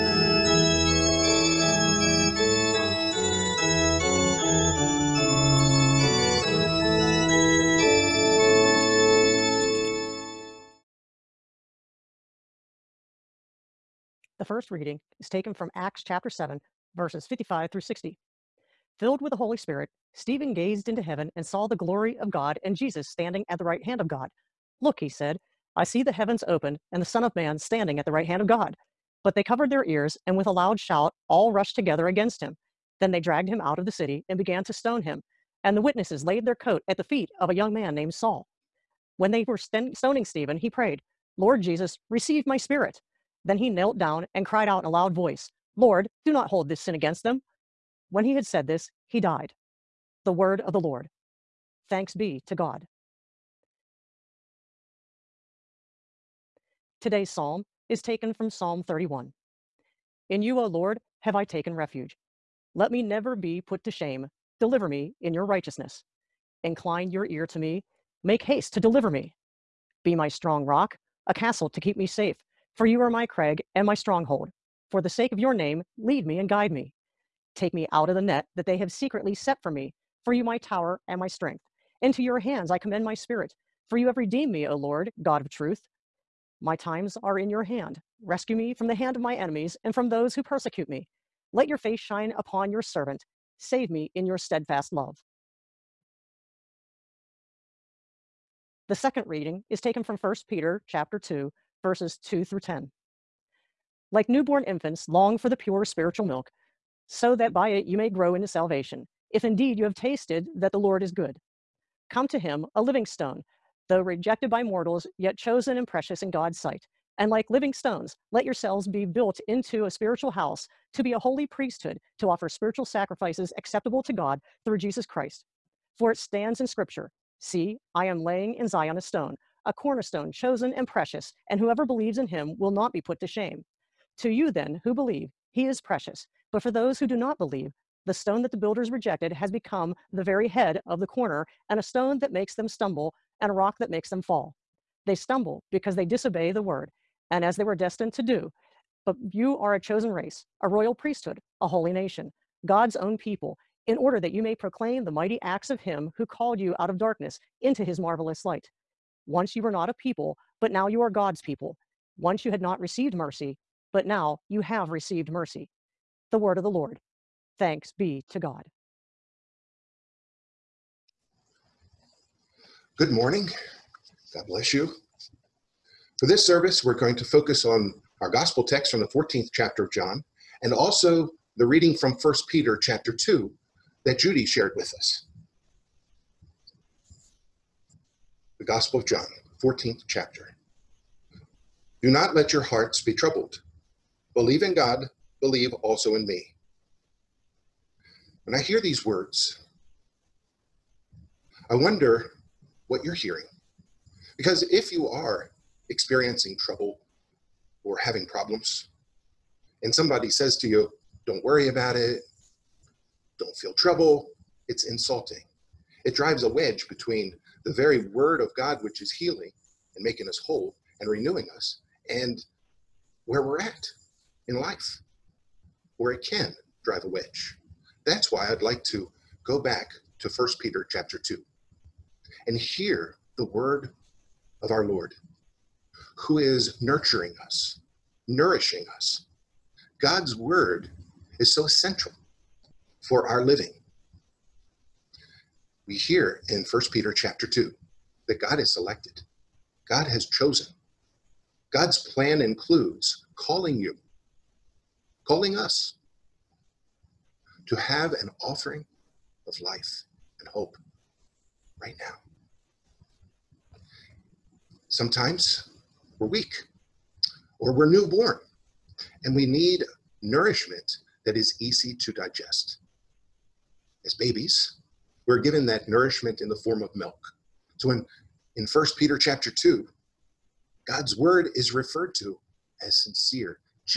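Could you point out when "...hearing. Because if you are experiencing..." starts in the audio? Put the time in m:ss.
3:23.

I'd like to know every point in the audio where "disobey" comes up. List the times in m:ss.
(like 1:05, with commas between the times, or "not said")
2:26.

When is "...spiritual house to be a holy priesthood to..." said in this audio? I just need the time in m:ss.
1:59.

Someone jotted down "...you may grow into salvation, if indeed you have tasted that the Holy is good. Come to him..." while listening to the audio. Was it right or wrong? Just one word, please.
wrong.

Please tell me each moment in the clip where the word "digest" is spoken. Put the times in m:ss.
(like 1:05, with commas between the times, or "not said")
4:32.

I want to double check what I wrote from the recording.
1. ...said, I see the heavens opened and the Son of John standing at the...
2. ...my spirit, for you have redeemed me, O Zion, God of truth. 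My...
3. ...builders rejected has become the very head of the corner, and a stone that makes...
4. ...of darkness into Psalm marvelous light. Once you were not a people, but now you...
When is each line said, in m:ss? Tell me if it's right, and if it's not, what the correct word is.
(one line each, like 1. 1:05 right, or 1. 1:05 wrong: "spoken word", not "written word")
1. 0:25 wrong: "Man", not "John"
2. 1:23 wrong: "Lord", not "Zion"
3. 2:18 right
4. 2:36 wrong: "His", not "Psalm".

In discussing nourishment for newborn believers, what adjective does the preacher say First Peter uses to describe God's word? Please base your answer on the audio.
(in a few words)
sincere.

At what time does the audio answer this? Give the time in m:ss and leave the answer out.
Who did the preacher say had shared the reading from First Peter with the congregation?
3:04.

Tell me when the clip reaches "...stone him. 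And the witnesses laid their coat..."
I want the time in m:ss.
0:34.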